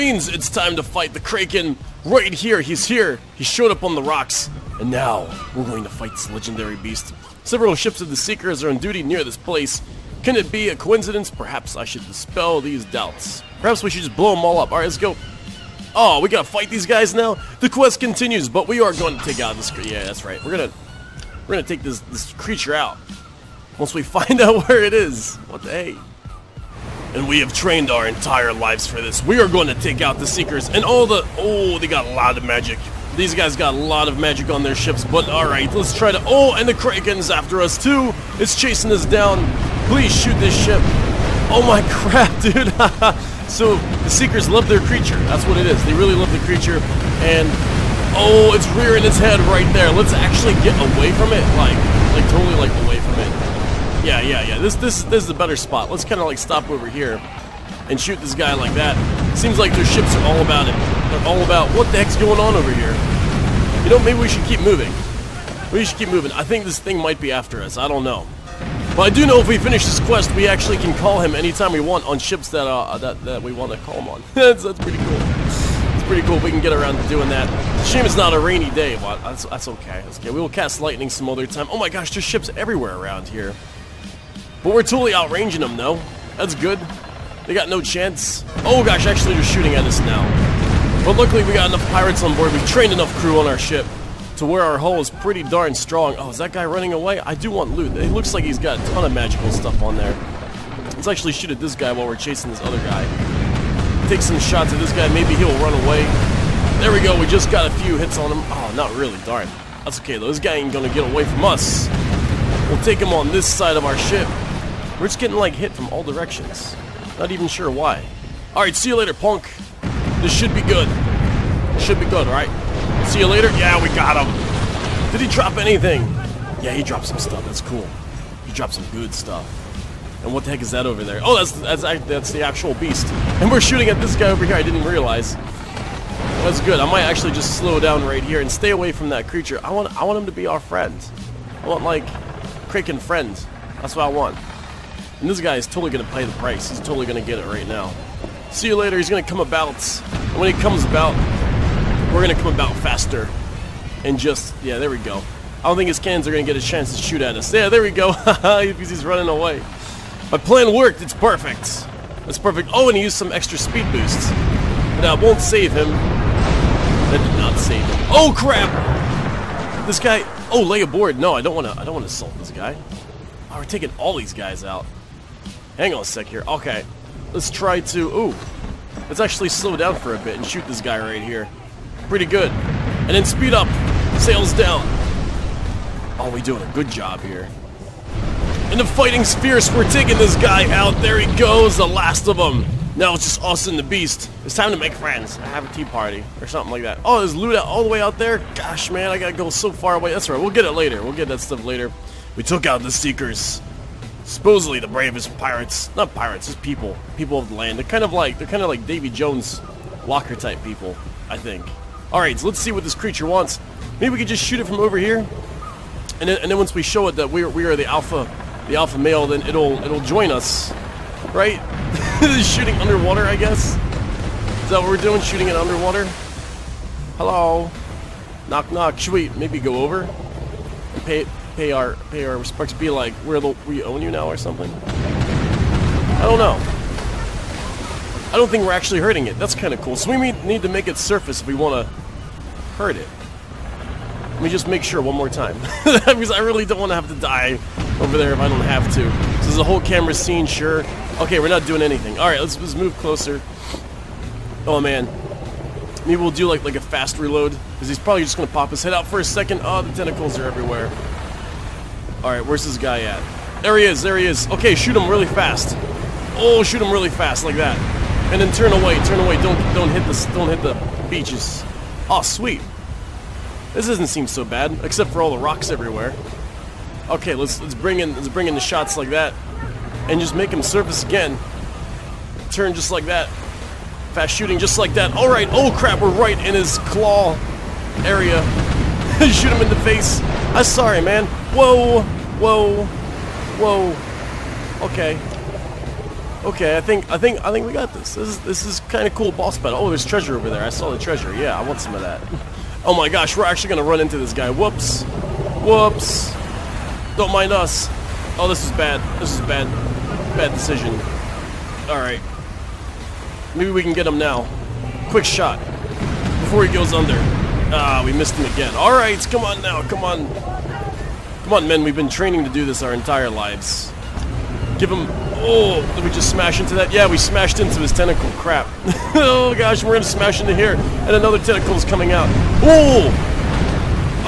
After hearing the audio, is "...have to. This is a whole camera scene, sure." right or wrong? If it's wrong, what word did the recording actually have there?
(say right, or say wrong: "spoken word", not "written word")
right.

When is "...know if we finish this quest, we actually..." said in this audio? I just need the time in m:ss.
1:09.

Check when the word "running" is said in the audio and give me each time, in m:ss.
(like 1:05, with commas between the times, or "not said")
1:36, 2:39.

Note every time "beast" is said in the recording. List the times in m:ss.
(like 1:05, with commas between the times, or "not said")
0:06, 2:12, 3:13.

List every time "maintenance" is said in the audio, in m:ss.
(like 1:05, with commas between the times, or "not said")
not said.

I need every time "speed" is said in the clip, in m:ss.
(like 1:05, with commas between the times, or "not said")
2:43, 3:03.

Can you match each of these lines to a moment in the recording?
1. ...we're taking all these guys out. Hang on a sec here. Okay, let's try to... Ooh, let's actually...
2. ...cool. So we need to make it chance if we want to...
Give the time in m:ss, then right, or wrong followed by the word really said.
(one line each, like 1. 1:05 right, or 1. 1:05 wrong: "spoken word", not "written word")
1. 2:53 right
2. 3:59 wrong: "surface", not "chance".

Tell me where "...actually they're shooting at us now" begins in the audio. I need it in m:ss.
1:29.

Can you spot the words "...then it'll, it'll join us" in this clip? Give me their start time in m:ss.
3:39.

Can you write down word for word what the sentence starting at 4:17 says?
Because he's probably just going to pop his head out for a second.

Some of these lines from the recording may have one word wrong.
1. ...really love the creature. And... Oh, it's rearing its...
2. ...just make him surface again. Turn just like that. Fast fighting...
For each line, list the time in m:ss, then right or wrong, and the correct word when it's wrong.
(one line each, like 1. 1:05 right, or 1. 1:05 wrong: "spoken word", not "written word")
1. 0:45 right
2. 4:40 wrong: "shooting", not "fighting".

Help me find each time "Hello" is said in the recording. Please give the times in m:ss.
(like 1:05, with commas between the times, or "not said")
3:47.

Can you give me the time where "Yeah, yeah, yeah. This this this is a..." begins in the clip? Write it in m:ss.
0:54.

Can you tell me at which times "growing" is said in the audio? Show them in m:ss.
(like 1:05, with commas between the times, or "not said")
not said.